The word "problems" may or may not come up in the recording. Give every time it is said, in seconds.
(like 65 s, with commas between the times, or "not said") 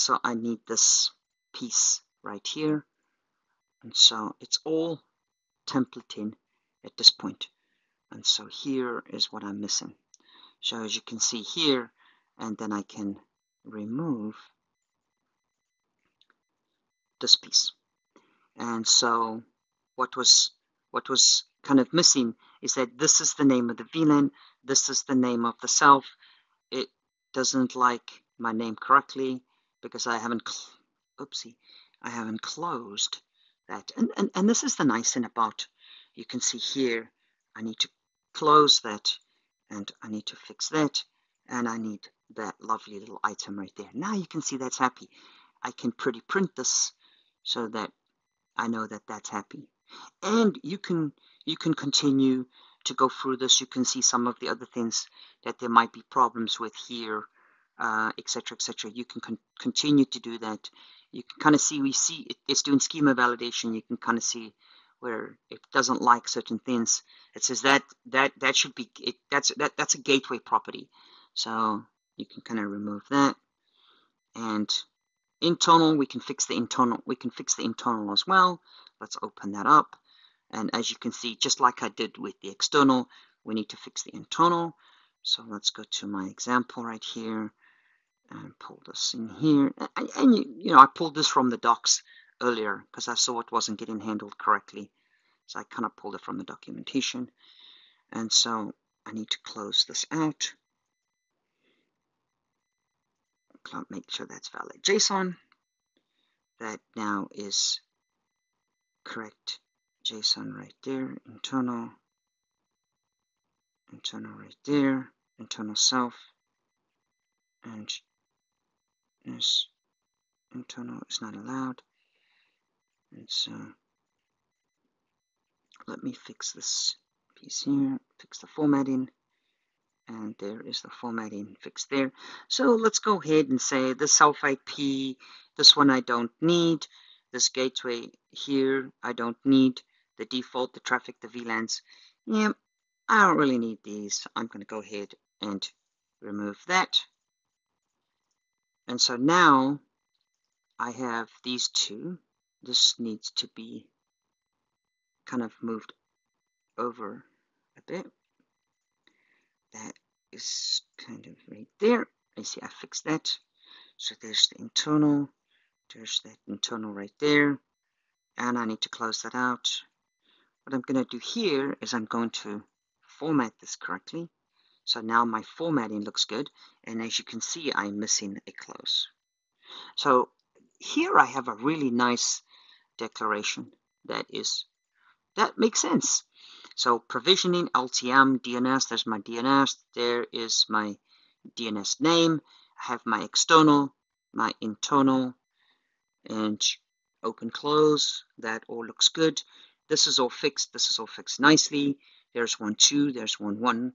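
56 s.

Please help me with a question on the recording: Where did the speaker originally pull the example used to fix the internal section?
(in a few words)
The documentation.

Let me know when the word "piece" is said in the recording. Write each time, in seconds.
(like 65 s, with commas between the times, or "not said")
1 s, 17 s, 127 s.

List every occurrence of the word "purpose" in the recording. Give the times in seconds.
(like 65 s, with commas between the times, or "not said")
not said.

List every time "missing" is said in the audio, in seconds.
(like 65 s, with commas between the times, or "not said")
9 s, 21 s, 177 s.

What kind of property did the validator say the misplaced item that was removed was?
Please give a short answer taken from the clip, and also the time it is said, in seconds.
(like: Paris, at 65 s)
Gateway property, at 70 s.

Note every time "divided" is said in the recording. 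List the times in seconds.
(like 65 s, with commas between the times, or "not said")
not said.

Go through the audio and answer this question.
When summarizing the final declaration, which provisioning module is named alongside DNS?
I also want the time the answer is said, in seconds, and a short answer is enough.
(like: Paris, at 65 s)
LTM, at 187 s.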